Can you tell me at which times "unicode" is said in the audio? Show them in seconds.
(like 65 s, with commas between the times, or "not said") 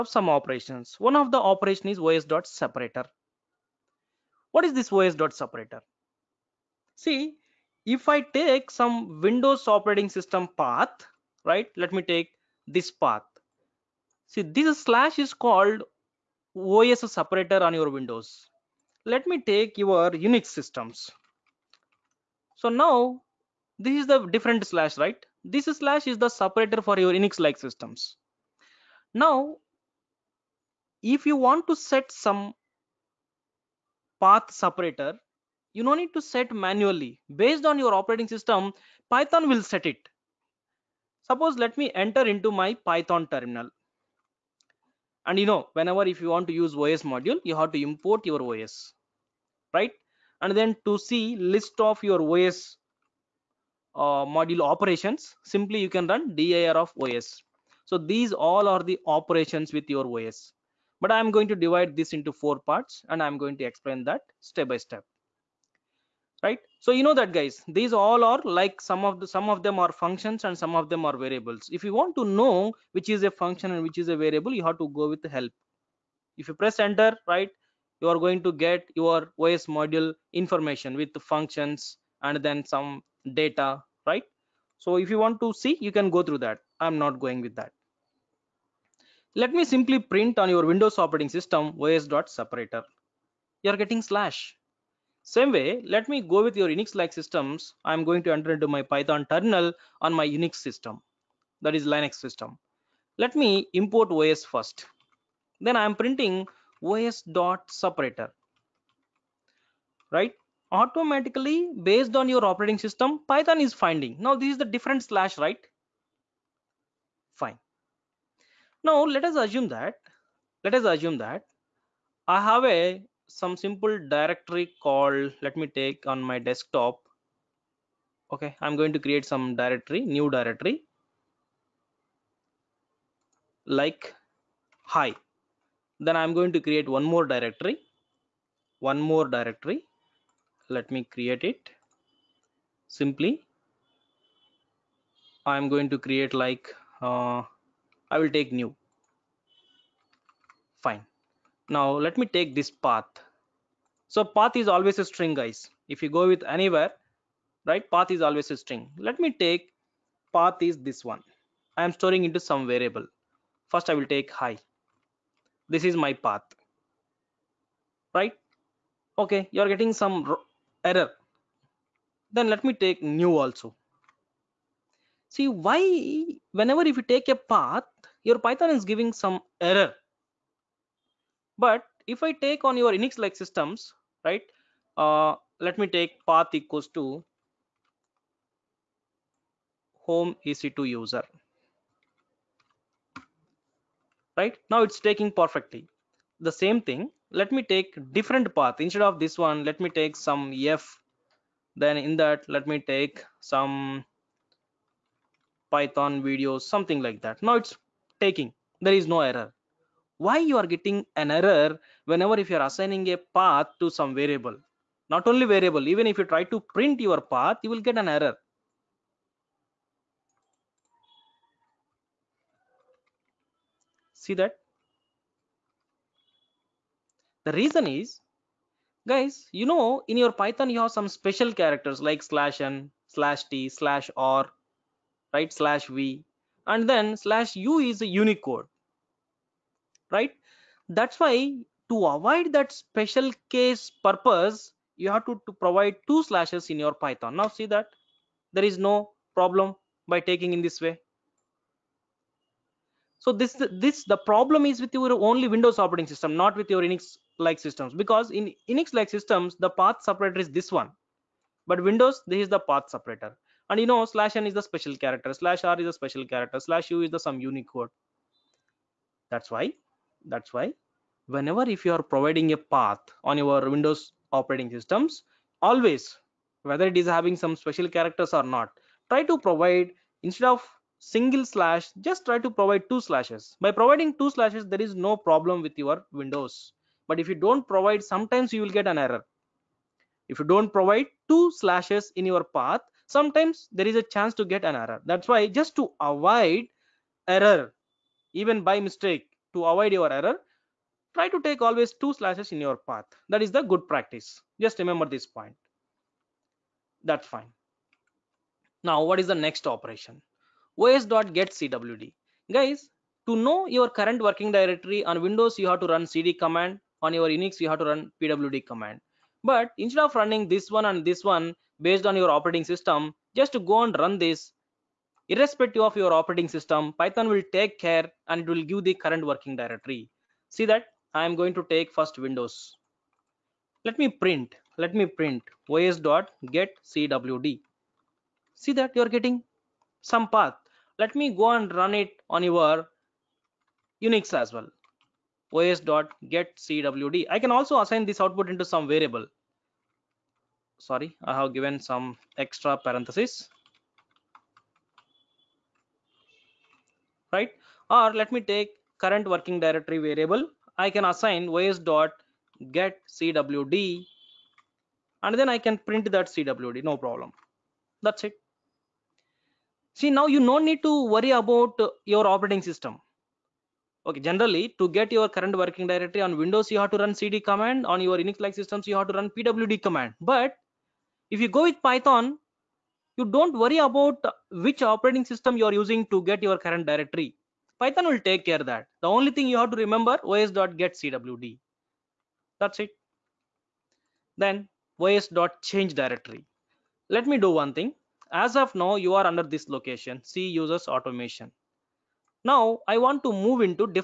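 238 s.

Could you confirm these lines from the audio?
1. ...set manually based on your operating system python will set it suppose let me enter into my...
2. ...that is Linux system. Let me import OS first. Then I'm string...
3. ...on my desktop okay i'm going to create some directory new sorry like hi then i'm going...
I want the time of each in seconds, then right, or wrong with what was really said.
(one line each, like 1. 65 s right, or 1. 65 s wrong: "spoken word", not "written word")
1. 36 s right
2. 101 s wrong: "printing", not "string"
3. 126 s wrong: "directory", not "sorry".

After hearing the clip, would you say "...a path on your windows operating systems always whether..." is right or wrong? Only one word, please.
right.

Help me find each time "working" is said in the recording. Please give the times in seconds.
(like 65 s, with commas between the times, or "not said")
314 s, 329 s, 359 s, 375 s.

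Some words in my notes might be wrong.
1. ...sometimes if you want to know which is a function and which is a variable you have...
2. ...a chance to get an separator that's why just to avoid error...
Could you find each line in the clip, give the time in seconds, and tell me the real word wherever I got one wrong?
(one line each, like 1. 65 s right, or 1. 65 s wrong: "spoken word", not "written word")
1. 71 s wrong: "variables", not "sometimes"
2. 293 s wrong: "error", not "separator".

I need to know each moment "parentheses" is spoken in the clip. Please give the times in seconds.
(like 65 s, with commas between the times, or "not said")
352 s.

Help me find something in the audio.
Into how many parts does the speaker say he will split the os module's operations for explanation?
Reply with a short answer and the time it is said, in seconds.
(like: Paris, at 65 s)
4, at 62 s.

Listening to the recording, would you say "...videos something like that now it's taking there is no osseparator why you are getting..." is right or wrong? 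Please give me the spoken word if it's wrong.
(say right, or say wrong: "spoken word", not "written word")
wrong: "error", not "osseparator".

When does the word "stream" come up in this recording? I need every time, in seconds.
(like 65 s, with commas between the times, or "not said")
not said.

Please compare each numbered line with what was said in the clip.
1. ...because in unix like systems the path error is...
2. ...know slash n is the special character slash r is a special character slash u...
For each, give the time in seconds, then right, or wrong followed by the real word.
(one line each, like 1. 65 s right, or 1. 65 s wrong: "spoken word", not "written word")
1. 257 s wrong: "separator", not "error"
2. 263 s right.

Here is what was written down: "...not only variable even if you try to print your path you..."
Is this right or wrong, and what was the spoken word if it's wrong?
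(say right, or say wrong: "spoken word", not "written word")
right.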